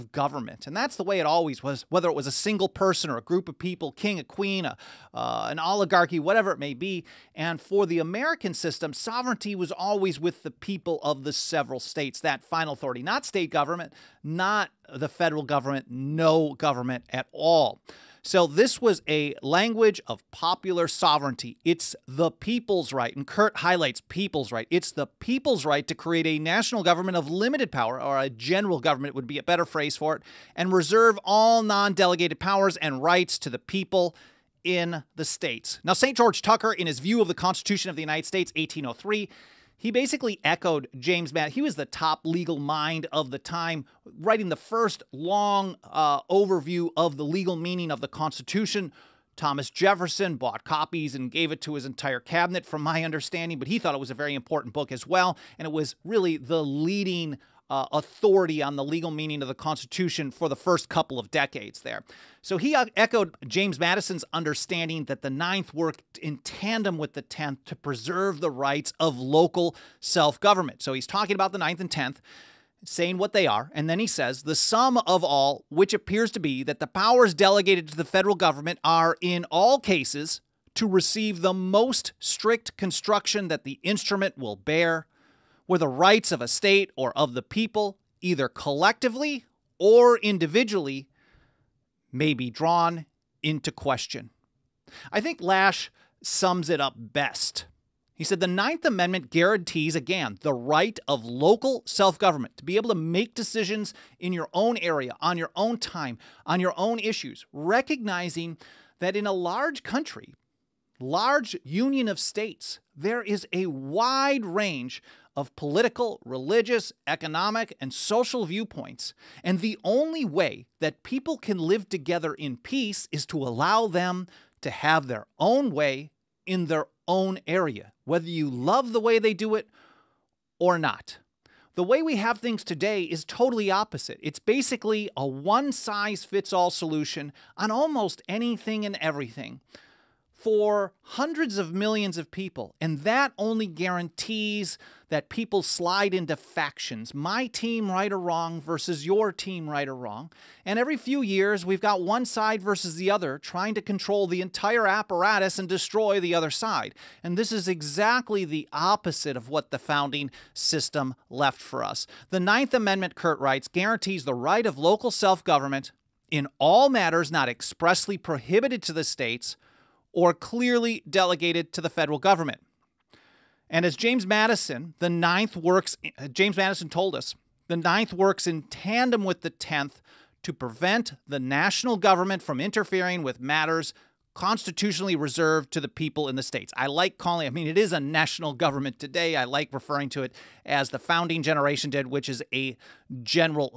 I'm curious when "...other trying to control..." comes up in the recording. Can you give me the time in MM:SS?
02:33.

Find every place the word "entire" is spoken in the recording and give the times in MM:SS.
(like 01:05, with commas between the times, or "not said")
00:51, 02:34.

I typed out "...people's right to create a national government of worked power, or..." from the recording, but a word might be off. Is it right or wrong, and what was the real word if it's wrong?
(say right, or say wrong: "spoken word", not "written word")
wrong: "limited", not "worked".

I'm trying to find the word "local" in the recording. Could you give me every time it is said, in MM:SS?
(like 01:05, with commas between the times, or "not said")
01:09, 01:41, 02:44.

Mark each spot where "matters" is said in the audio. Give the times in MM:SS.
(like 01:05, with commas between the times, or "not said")
02:46, 03:03.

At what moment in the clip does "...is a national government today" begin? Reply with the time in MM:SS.
03:07.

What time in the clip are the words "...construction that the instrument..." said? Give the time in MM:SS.
01:22.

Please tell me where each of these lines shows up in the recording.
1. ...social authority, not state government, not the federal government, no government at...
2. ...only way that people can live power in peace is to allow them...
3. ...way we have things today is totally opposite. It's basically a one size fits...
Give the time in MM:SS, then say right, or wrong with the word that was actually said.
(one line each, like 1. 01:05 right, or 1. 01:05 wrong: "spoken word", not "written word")
1. 00:12 wrong: "final", not "social"
2. 01:59 wrong: "together", not "power"
3. 02:11 right.